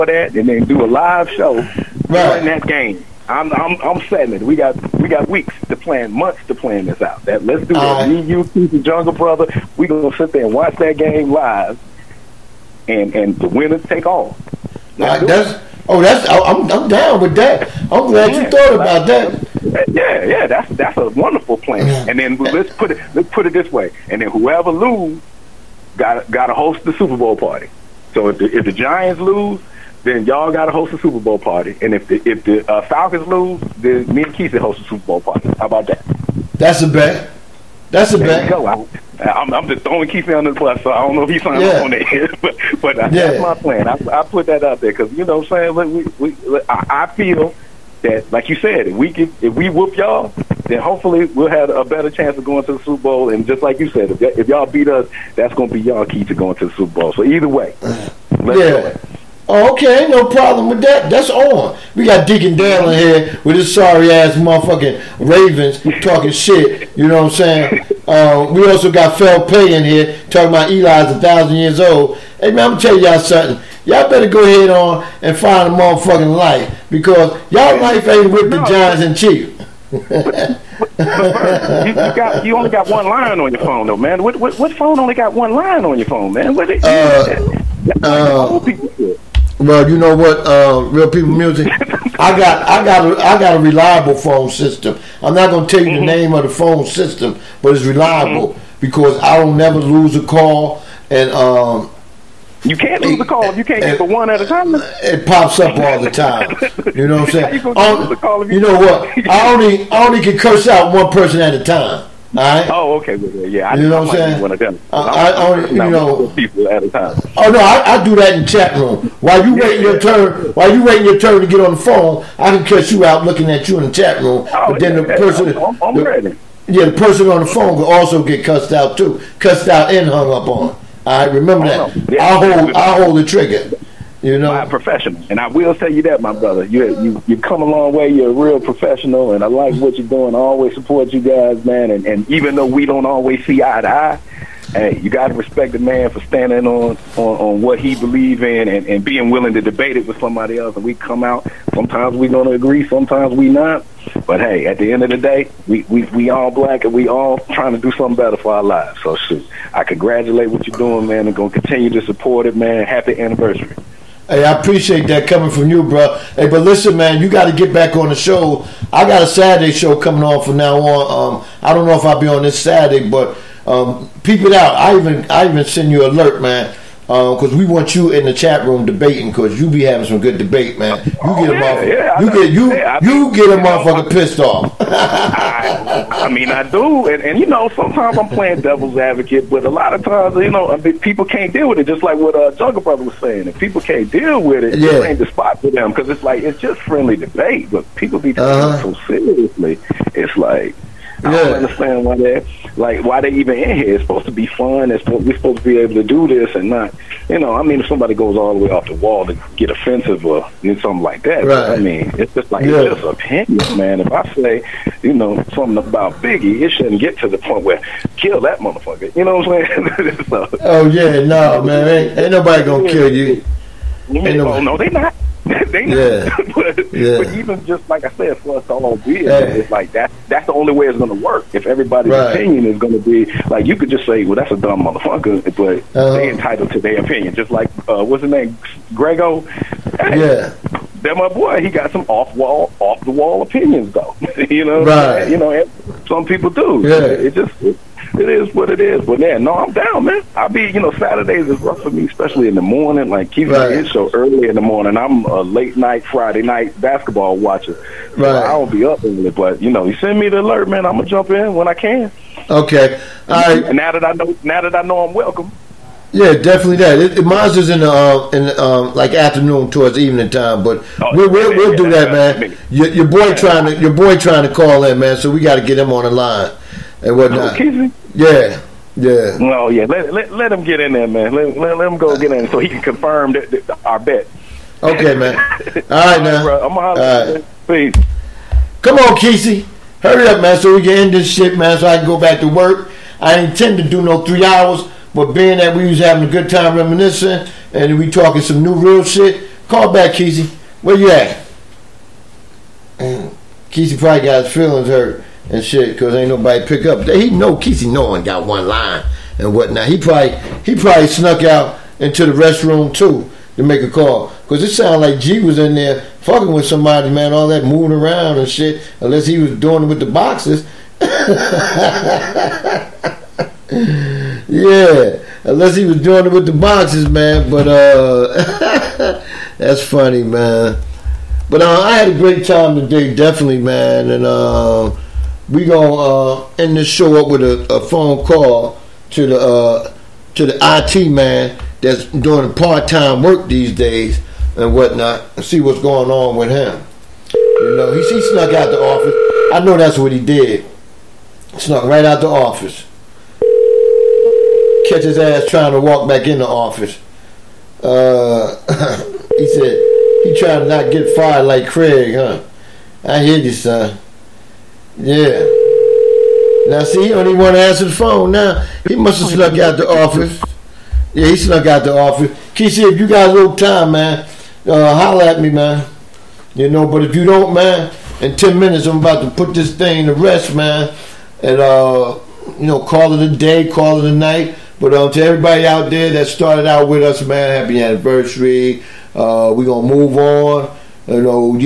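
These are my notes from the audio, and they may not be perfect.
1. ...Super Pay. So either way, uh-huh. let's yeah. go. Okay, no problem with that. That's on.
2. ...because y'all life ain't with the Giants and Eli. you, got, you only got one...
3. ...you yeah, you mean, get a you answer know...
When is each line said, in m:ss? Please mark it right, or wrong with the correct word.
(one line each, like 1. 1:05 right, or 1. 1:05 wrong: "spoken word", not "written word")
1. 0:56 wrong: "Bowl", not "Pay"
2. 1:16 wrong: "Chiefs", not "Eli"
3. 3:02 wrong: "motherfucker", not "answer".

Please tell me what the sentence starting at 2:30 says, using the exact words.
And we come out, sometimes we're gonna agree, sometimes we not.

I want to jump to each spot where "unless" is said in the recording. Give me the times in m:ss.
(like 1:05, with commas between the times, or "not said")
5:19, 5:25.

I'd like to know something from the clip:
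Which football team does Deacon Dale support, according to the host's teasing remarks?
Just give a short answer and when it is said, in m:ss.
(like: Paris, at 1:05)
Ravens, at 1:05.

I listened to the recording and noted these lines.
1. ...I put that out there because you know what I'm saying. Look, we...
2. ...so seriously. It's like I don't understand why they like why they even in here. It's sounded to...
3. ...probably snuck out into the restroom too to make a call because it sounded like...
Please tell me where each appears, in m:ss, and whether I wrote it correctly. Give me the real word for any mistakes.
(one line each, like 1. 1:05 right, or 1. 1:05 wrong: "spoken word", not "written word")
1. 0:44 right
2. 3:18 wrong: "supposed", not "sounded"
3. 5:10 right.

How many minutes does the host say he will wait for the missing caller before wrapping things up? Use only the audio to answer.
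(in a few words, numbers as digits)
10.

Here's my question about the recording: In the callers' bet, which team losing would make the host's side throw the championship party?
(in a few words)
Falcons.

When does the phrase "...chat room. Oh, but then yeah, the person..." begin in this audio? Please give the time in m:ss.
2:03.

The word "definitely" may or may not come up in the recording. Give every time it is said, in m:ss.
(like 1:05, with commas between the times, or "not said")
4:26, 5:33.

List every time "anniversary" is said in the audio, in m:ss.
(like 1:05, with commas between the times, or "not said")
2:43, 6:27.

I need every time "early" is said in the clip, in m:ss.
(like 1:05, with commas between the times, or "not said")
4:14, 4:19.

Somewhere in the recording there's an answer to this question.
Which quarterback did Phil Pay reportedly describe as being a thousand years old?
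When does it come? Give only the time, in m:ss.
1:10.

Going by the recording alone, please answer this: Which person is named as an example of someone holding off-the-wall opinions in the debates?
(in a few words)
Grego.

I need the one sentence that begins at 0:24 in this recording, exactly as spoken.
And then whoever lose, got got to host the Super Bowl party.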